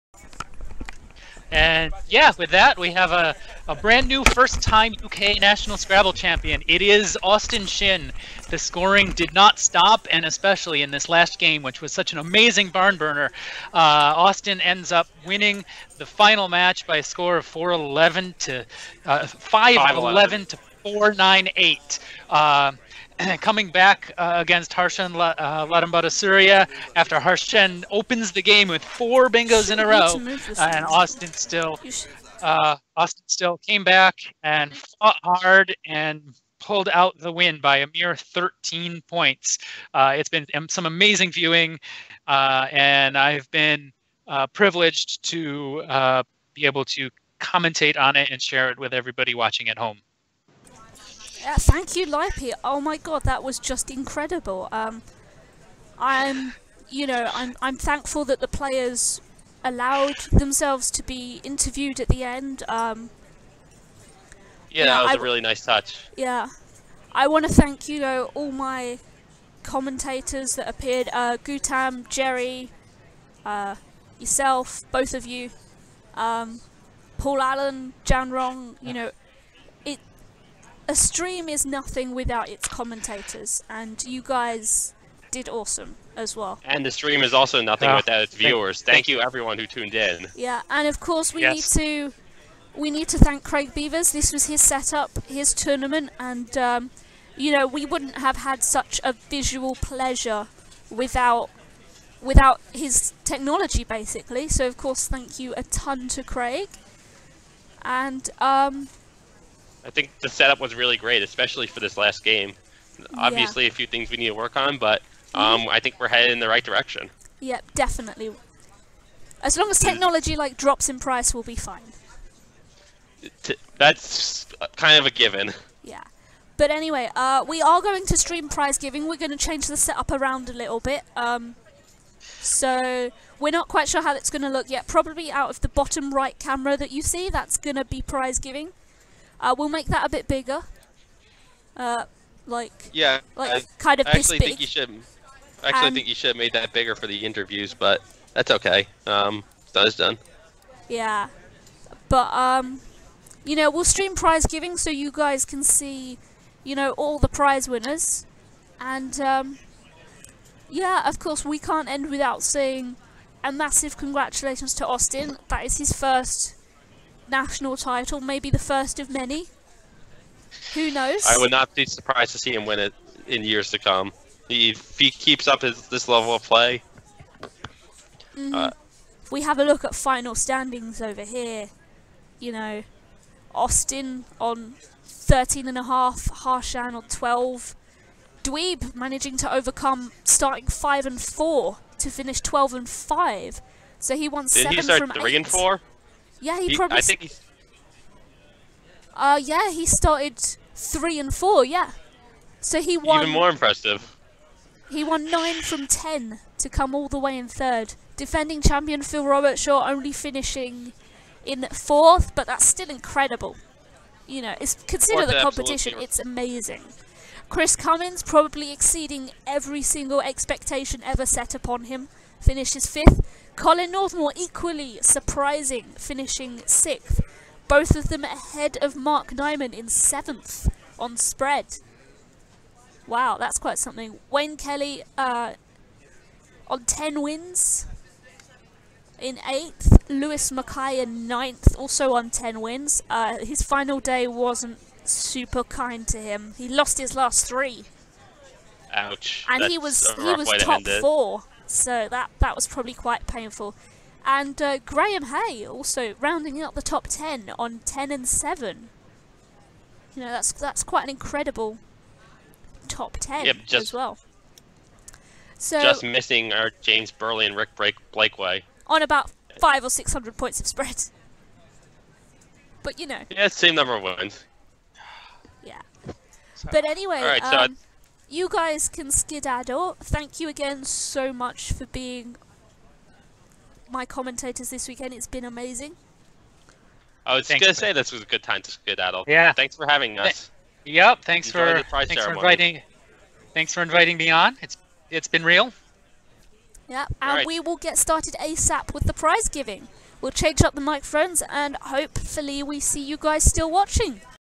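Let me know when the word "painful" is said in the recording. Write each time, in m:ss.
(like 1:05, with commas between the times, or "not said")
4:13.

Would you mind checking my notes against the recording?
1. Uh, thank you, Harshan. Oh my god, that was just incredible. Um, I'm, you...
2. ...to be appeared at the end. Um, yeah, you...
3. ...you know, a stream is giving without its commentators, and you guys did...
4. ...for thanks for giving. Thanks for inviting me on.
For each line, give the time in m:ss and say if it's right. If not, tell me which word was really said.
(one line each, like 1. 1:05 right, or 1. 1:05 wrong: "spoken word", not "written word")
1. 0:51 wrong: "Lipy", not "Harshan"
2. 1:00 wrong: "interviewed", not "appeared"
3. 1:18 wrong: "nothing", not "giving"
4. 4:51 wrong: "inviting", not "giving".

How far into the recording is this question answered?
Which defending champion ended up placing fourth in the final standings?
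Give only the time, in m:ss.
3:29.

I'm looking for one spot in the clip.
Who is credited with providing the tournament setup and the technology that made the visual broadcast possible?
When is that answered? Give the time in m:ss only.
1:33.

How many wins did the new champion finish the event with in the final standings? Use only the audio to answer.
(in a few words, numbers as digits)
13 and a half.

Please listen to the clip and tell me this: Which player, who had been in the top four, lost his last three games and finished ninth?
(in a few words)
Lewis Mackay.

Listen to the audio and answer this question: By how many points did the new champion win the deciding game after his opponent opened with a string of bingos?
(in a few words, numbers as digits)
13.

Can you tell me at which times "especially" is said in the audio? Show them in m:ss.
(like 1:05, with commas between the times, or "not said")
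0:10, 1:51.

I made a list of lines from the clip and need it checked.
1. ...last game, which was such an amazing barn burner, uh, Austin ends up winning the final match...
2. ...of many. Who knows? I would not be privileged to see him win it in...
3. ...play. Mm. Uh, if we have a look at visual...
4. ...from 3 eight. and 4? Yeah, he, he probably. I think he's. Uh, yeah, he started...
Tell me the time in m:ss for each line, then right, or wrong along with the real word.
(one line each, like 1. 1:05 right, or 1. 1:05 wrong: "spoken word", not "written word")
1. 0:11 right
2. 2:48 wrong: "surprised", not "privileged"
3. 2:56 wrong: "final", not "visual"
4. 3:14 right.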